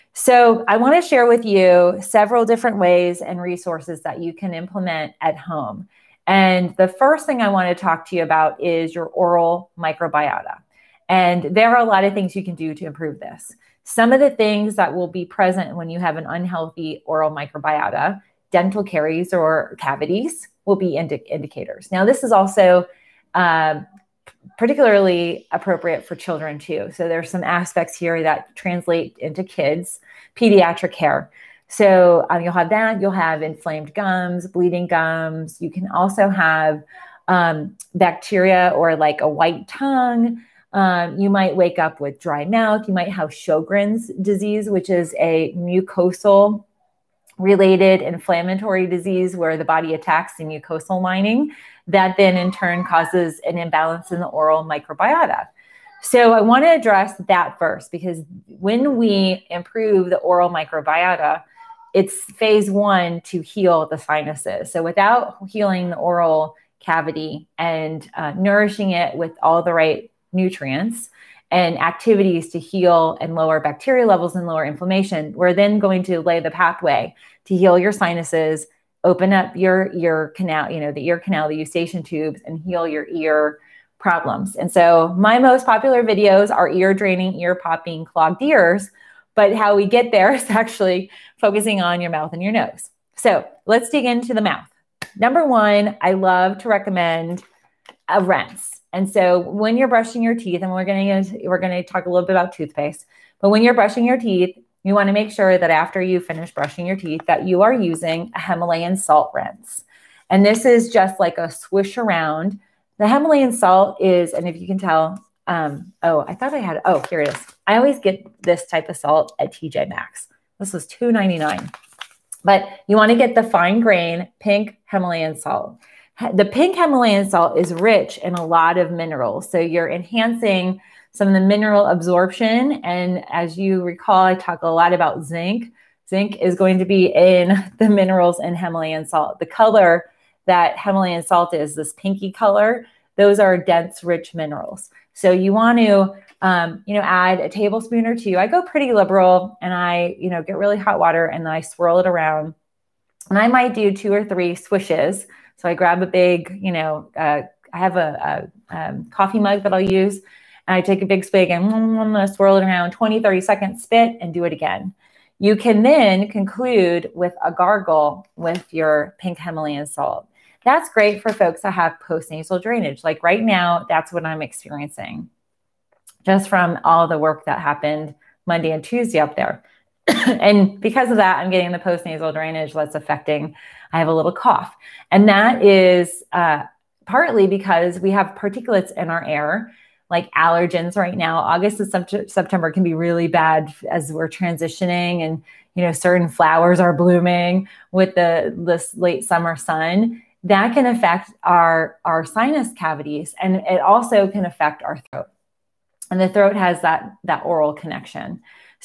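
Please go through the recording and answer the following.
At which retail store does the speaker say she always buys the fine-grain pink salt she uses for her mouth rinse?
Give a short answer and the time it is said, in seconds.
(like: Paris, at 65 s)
TJ Maxx, at 119 s.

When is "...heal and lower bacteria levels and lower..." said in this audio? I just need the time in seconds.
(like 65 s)
72 s.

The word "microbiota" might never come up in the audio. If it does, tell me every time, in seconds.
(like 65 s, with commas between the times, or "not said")
9 s, 17 s, 54 s, 60 s.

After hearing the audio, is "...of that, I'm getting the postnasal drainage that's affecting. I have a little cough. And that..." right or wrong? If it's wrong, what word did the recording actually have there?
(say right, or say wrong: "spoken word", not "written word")
right.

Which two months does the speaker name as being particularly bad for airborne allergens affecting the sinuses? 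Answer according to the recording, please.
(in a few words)
August and September.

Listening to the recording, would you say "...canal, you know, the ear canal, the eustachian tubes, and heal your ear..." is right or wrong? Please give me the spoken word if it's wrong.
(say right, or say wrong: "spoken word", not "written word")
right.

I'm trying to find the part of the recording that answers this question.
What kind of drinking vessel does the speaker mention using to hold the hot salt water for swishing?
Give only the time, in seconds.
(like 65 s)
159 s.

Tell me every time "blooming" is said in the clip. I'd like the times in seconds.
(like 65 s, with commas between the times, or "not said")
196 s.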